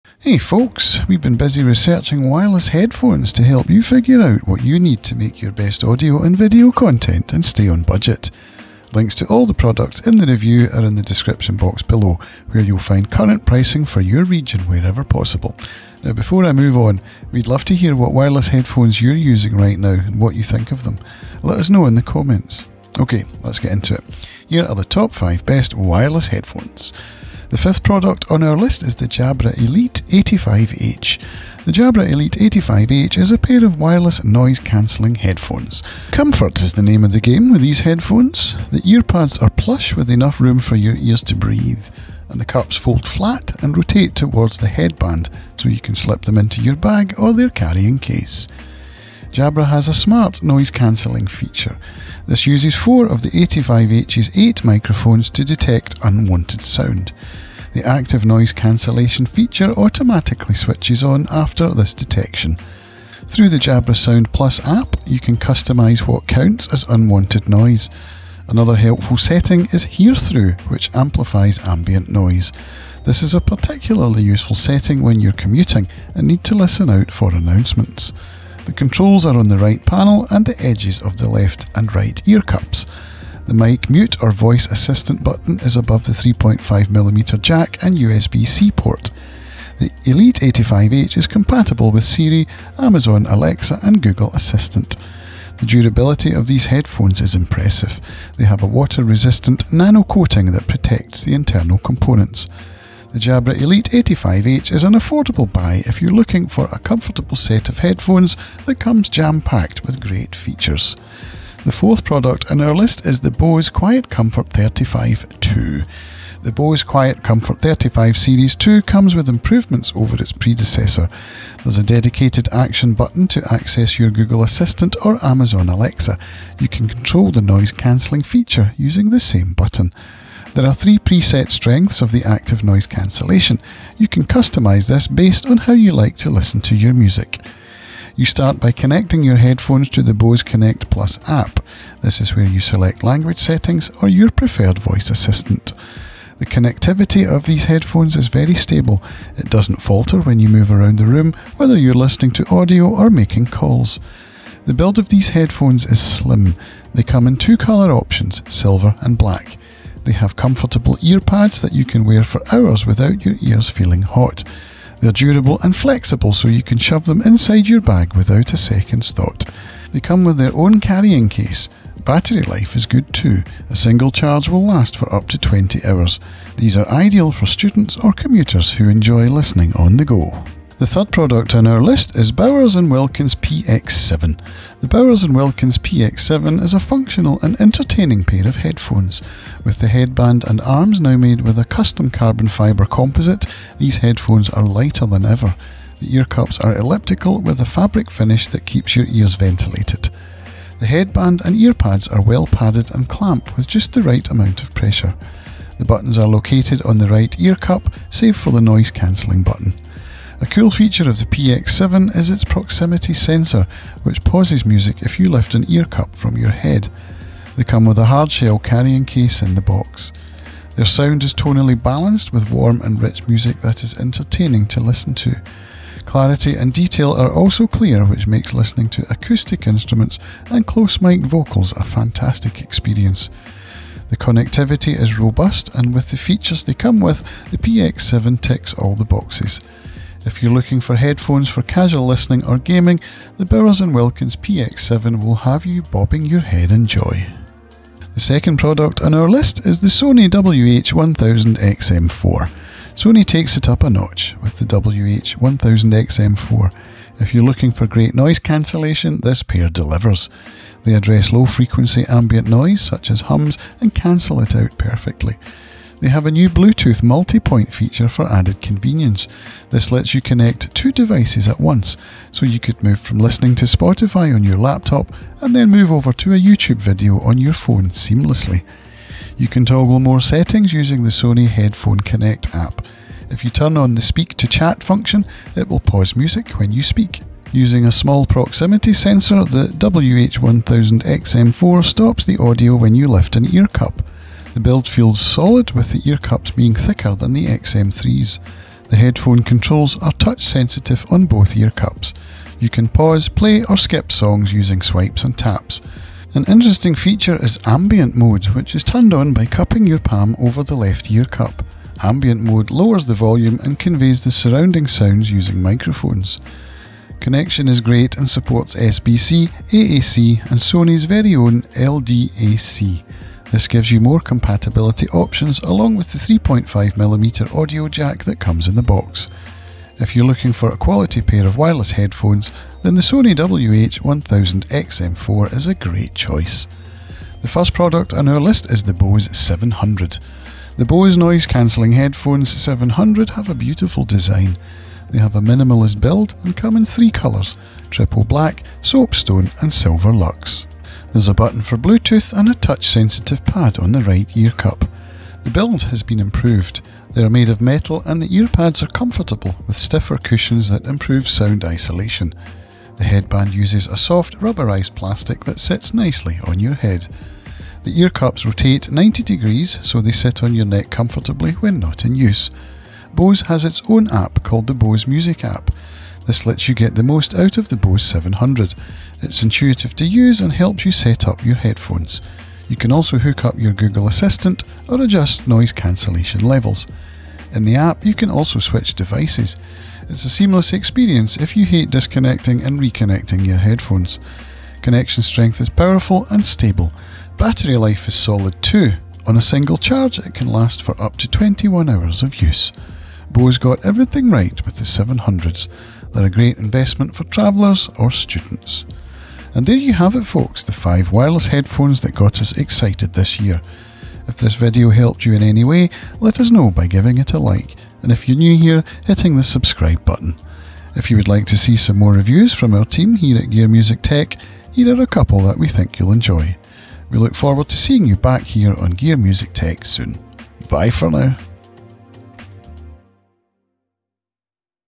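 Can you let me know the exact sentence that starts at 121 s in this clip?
There's a dedicated action button to access your Google Assistant or Amazon Alexa.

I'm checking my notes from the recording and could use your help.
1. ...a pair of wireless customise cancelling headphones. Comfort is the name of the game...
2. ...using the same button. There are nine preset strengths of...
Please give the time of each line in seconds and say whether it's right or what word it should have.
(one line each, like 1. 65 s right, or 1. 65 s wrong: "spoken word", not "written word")
1. 33 s wrong: "noise", not "customise"
2. 128 s wrong: "three", not "nine".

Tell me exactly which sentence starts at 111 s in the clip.
The fourth product on our list is the Bose Quiet Comfort 35 II.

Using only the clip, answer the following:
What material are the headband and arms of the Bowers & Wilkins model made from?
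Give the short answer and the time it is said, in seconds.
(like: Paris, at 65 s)
carbon fibre composite, at 192 s.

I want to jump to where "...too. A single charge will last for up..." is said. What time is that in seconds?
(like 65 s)
173 s.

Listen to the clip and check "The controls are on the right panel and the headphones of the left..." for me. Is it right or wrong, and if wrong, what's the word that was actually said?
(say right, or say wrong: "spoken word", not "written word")
wrong: "edges", not "headphones".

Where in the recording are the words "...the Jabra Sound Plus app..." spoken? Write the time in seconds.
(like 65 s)
63 s.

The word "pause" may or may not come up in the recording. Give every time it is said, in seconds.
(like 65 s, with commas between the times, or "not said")
214 s, 285 s, 302 s.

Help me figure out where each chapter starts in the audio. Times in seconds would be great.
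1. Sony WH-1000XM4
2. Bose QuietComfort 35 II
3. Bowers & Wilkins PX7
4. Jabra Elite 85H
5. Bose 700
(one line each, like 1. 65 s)
1. 247 s
2. 111 s
3. 180 s
4. 27 s
5. 336 s.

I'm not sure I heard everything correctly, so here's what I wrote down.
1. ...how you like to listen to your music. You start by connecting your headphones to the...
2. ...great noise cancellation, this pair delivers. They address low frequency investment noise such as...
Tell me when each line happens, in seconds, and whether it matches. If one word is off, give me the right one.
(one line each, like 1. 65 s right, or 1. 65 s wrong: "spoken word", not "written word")
1. 135 s right
2. 257 s wrong: "ambient", not "investment".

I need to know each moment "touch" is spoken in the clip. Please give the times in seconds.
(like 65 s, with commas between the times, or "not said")
300 s, 352 s.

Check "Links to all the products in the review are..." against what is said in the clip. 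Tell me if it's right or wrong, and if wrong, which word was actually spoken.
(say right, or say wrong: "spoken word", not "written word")
right.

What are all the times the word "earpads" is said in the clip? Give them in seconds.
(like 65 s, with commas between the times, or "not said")
38 s, 358 s.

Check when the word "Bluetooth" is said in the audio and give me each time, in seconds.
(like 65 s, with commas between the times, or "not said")
266 s, 351 s.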